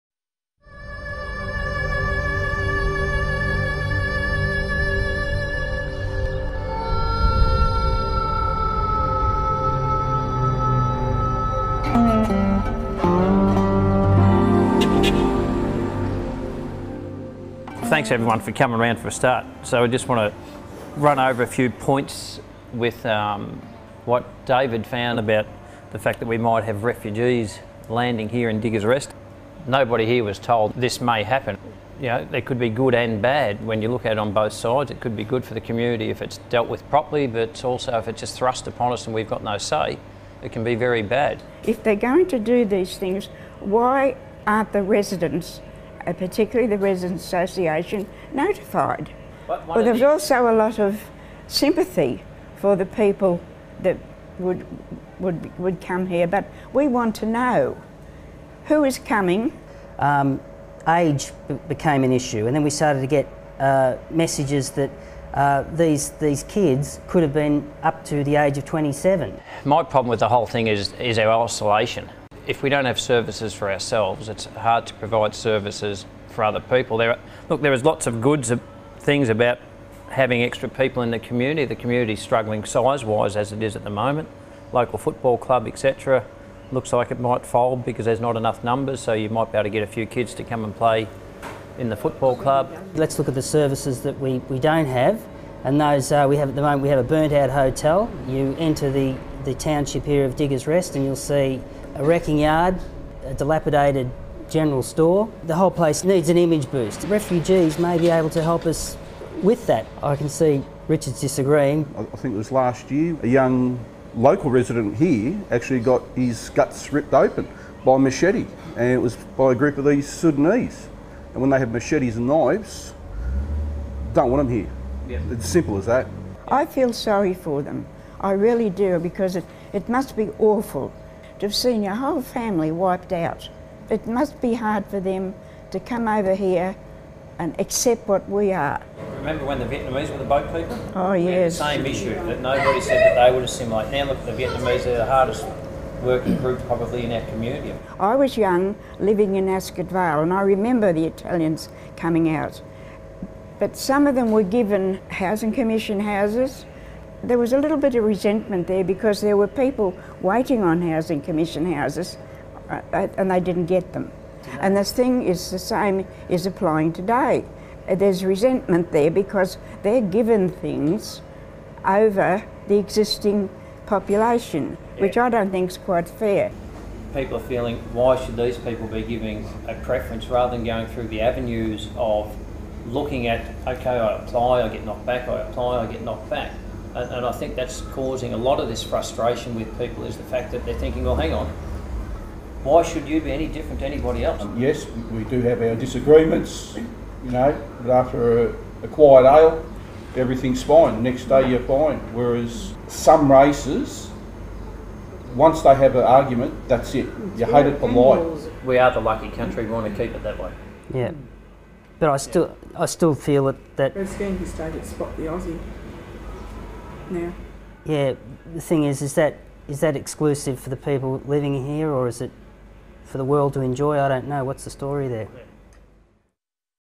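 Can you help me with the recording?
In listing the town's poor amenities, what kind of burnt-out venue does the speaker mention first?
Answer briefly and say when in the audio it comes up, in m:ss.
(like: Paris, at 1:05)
Hotel, at 1:37.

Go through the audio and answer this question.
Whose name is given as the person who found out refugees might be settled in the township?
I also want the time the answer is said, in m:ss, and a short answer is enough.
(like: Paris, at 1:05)
David, at 0:24.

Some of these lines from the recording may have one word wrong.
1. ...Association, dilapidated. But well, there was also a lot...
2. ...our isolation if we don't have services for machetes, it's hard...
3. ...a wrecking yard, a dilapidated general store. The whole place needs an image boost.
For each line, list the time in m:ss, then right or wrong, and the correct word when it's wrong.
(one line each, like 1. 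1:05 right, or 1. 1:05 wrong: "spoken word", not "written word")
1. 0:47 wrong: "notified", not "dilapidated"
2. 1:11 wrong: "ourselves", not "machetes"
3. 1:41 right.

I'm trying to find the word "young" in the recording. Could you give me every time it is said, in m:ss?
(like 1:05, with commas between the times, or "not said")
1:53, 2:28.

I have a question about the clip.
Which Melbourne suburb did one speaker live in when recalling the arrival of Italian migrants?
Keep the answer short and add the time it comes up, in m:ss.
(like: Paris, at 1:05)
Ascot Vale, at 2:29.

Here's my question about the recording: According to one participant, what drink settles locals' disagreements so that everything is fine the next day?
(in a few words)
A quiet ale.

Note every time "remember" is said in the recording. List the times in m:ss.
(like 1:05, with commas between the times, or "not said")
2:19, 2:30.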